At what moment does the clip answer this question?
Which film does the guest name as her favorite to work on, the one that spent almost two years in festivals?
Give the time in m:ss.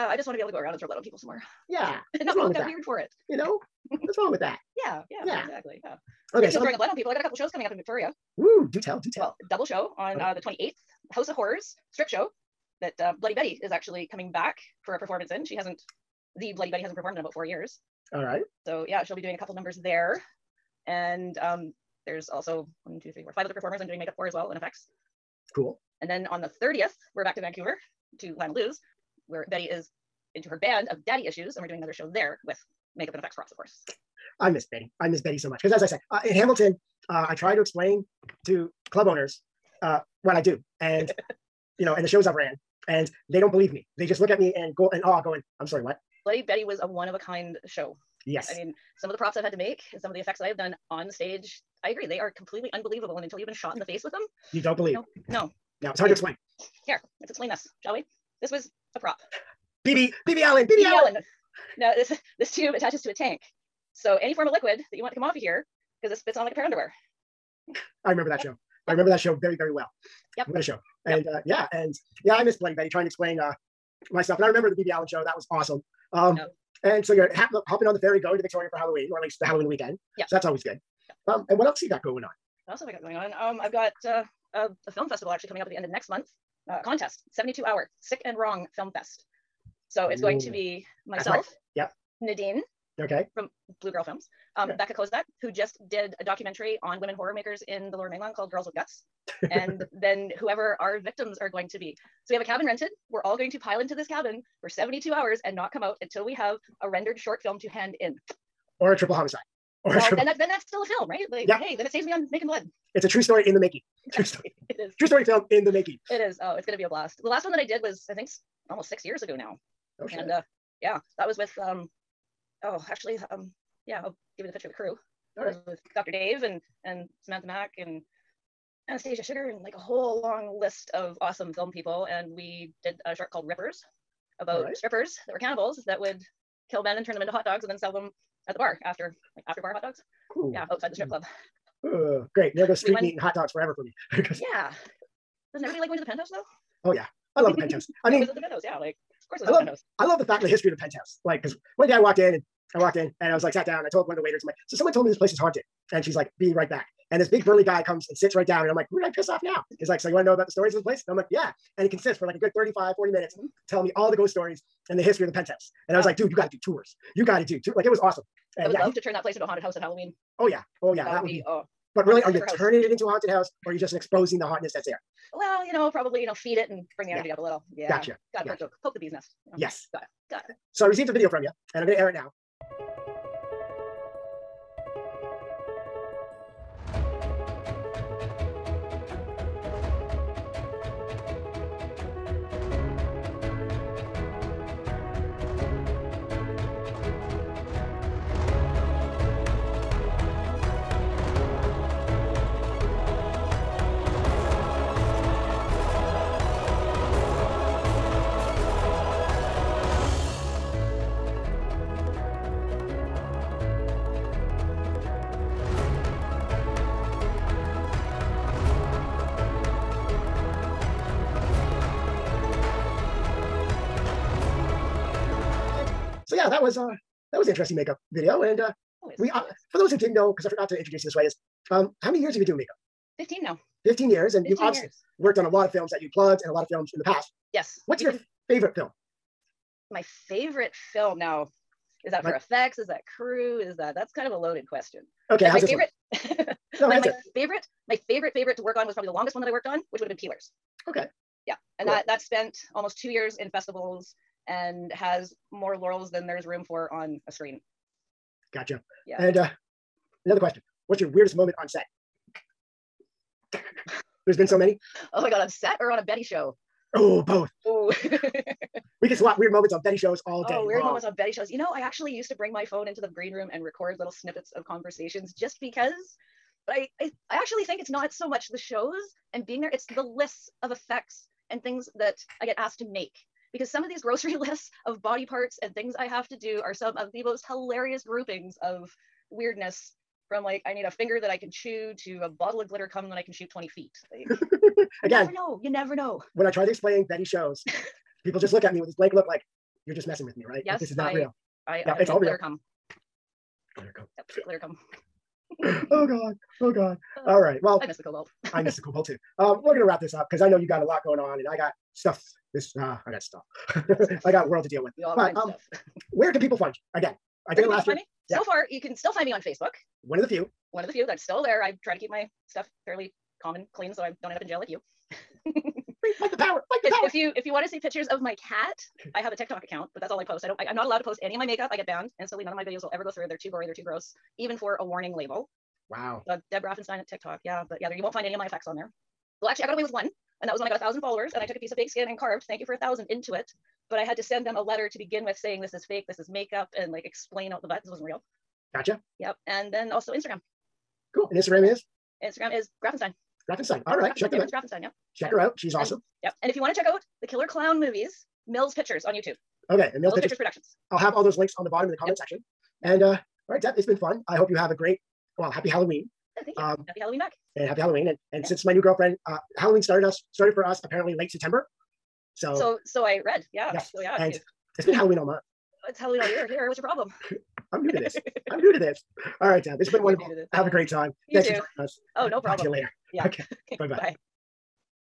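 4:10.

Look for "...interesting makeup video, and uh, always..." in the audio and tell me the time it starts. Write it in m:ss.
3:47.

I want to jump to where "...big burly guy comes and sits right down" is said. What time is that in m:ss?
2:37.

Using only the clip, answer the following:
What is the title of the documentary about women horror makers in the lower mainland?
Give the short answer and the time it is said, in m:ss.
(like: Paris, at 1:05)
Girls with Guts, at 1:38.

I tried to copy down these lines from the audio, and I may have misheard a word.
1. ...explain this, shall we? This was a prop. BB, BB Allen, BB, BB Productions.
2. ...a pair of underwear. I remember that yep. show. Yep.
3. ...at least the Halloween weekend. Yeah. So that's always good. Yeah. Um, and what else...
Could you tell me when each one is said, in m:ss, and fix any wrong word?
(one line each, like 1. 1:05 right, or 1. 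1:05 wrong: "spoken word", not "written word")
1. 0:57 wrong: "Allen", not "Productions"
2. 1:06 right
3. 1:19 right.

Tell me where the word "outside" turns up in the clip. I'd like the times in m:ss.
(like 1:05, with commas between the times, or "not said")
2:20.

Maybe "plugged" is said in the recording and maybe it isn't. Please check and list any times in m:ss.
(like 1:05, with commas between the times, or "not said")
3:56.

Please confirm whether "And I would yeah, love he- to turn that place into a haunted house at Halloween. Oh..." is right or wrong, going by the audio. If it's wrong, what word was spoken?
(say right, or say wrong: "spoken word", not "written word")
right.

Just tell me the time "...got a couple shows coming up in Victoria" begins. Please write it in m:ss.
0:07.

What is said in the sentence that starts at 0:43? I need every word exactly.
They just look at me and go and awe, oh, going, I'm sorry, what?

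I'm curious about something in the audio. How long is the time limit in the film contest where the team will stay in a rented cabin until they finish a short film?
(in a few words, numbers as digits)
72 hours.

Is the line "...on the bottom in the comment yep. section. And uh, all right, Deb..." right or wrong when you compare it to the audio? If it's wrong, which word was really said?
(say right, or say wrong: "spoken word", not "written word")
right.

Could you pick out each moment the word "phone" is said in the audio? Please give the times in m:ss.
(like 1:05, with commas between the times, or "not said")
4:32.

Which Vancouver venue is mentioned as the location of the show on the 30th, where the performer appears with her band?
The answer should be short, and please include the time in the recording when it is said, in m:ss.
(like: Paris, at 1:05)
Lanalou's, at 0:28.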